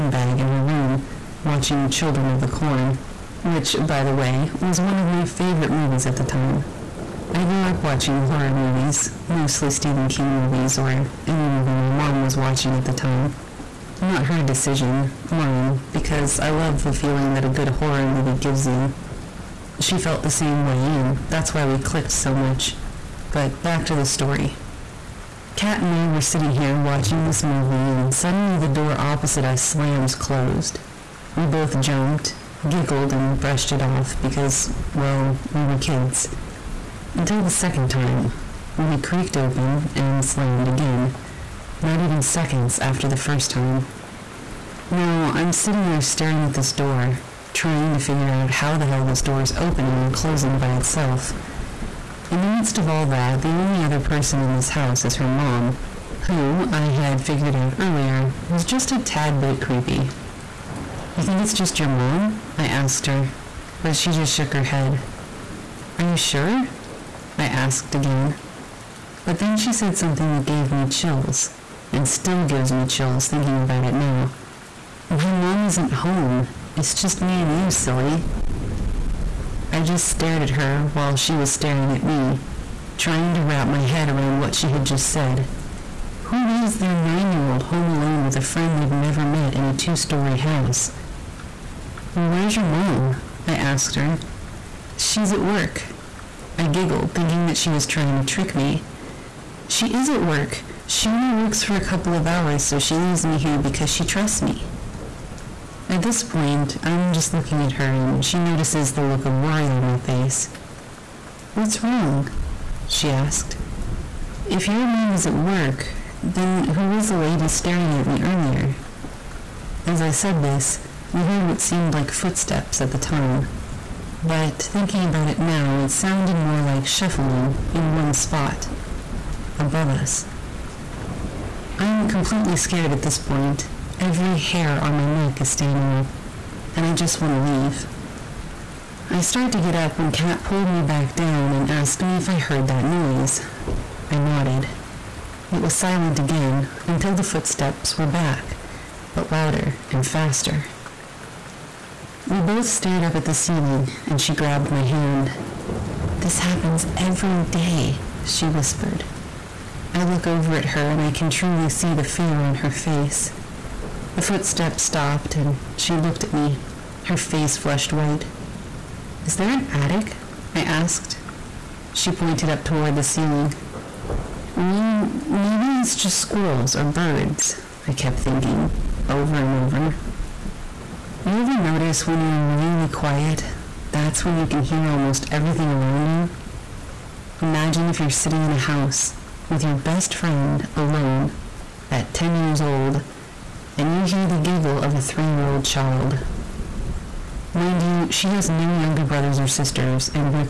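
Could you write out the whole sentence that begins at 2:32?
We both stared up at the ceiling, and she grabbed my hand.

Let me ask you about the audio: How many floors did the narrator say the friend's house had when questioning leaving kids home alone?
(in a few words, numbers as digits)
2.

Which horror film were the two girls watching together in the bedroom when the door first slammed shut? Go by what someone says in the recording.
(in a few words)
Children of the Corn.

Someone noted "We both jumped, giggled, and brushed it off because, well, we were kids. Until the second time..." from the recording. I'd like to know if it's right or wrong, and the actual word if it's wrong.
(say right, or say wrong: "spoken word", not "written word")
right.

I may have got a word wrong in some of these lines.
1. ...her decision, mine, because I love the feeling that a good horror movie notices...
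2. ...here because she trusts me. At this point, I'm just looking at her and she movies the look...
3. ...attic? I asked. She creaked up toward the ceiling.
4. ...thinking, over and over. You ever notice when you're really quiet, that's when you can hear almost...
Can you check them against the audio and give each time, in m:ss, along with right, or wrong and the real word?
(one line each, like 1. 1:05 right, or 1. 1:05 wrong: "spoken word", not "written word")
1. 0:14 wrong: "gives", not "notices"
2. 1:43 wrong: "notices", not "movies"
3. 2:49 wrong: "pointed", not "creaked"
4. 2:58 right.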